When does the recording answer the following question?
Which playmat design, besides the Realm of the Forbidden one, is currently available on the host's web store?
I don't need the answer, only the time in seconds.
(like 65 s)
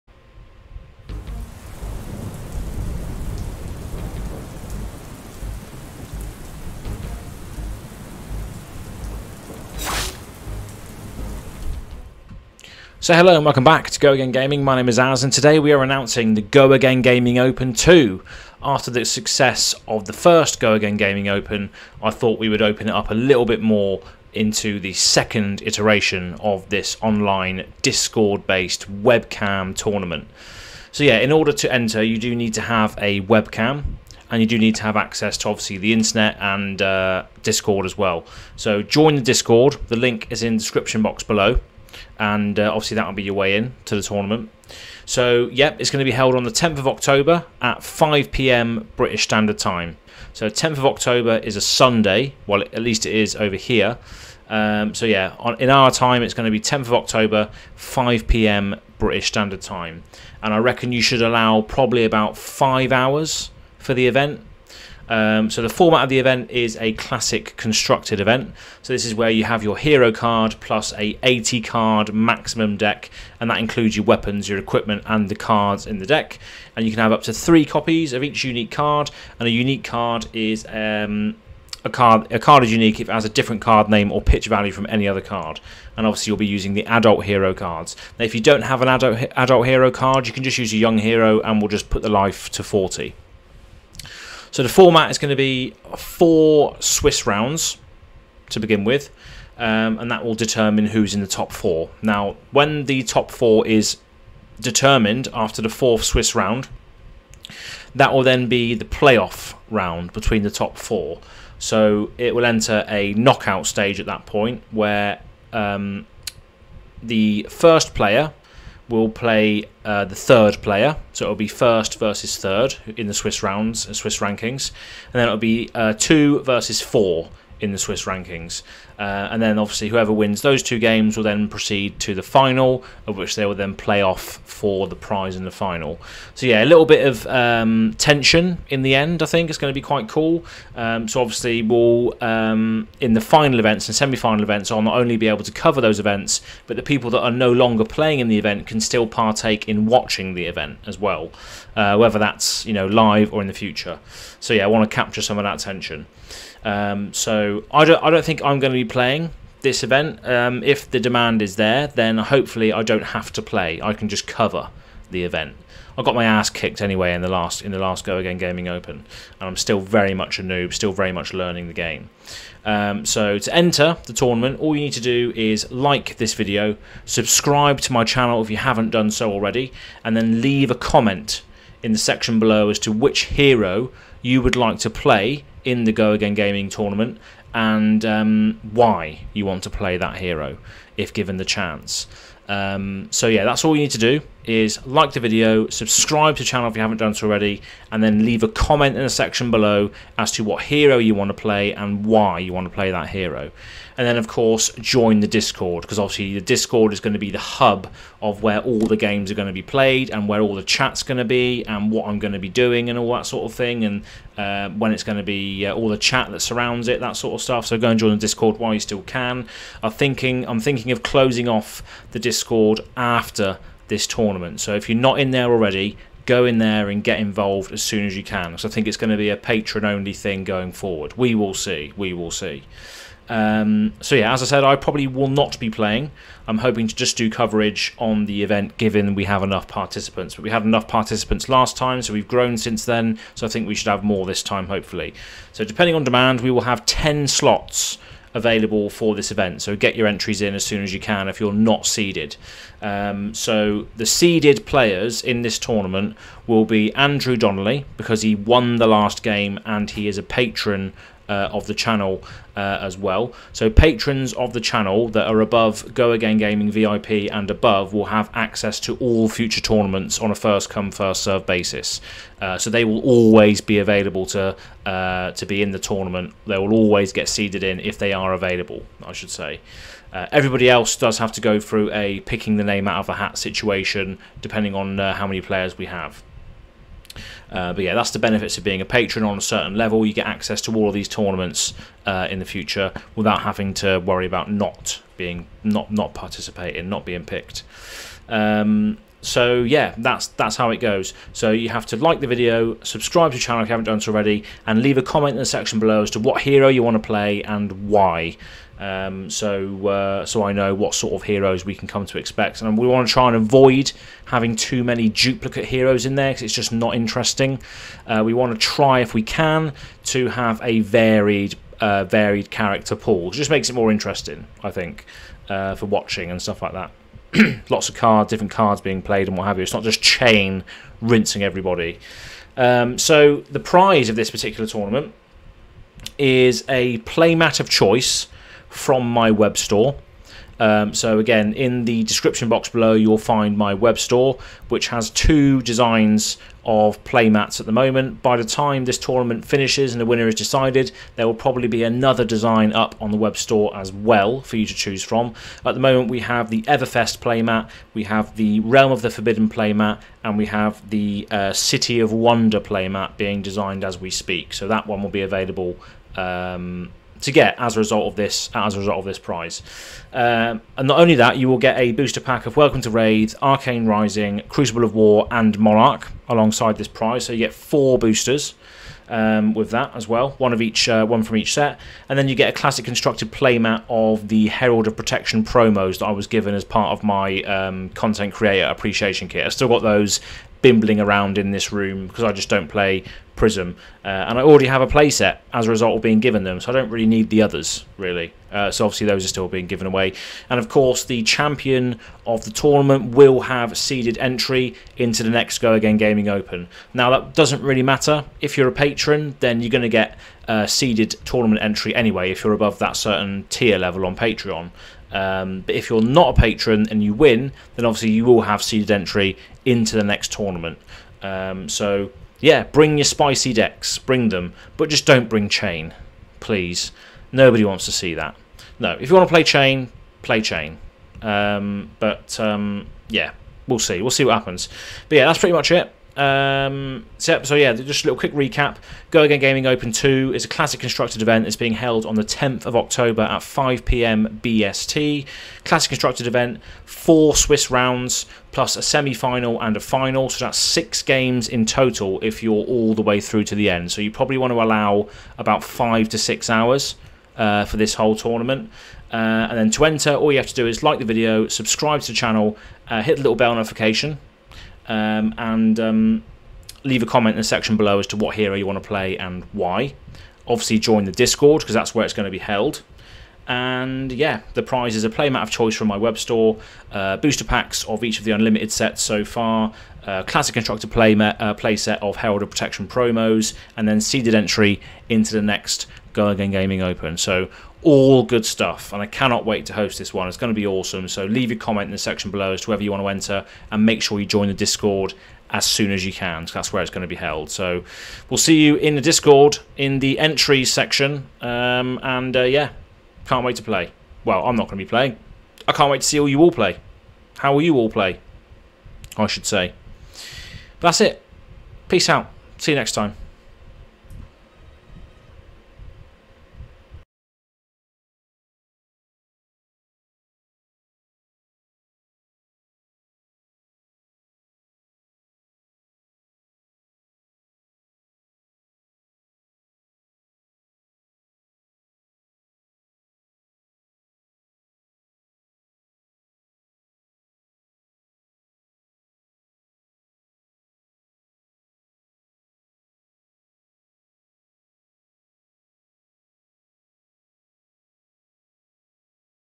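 356 s.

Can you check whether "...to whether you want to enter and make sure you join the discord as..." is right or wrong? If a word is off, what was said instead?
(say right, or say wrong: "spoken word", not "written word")
right.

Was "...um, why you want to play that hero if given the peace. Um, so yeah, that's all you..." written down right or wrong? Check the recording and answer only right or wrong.
wrong.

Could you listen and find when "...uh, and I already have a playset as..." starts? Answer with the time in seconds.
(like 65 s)
394 s.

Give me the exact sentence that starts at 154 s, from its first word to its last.
So yeah, I want to capture some of that tension.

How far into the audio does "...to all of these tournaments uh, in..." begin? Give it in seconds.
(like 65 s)
290 s.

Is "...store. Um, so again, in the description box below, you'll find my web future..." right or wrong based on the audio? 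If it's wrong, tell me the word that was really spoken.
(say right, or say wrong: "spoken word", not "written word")
wrong: "store", not "future".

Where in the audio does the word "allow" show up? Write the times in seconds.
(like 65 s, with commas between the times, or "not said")
61 s, 454 s.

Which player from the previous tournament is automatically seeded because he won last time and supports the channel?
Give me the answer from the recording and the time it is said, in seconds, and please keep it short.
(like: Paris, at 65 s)
Andrew Donnelly, at 256 s.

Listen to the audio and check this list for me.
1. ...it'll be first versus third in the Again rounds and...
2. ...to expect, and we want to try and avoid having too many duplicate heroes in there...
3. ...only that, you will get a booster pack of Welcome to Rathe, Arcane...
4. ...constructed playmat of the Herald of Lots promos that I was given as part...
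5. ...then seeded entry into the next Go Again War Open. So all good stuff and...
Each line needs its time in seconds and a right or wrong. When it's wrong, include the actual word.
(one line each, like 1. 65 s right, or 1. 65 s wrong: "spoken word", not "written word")
1. 121 s wrong: "Swiss", not "Again"
2. 312 s right
3. 370 s right
4. 382 s wrong: "Protection", not "Lots"
5. 483 s wrong: "Gaming", not "War".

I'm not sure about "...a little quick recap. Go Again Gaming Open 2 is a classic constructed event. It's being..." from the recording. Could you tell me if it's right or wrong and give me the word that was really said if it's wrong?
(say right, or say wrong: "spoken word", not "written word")
right.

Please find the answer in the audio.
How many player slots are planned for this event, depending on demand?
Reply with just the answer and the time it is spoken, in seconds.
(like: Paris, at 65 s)
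10, at 246 s.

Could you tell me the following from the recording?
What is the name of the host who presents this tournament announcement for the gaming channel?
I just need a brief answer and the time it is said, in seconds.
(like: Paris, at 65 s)
Az, at 14 s.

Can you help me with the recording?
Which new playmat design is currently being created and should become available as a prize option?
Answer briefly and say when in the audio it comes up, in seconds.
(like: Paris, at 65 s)
City of Wonder, at 361 s.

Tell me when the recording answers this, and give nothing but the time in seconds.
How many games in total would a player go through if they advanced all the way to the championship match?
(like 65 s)
450 s.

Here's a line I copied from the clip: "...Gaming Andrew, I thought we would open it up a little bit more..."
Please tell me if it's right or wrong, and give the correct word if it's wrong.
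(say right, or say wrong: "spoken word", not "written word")
wrong: "Open", not "Andrew".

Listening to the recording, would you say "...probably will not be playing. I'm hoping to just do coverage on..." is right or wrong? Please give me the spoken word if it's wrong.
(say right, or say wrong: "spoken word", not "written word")
right.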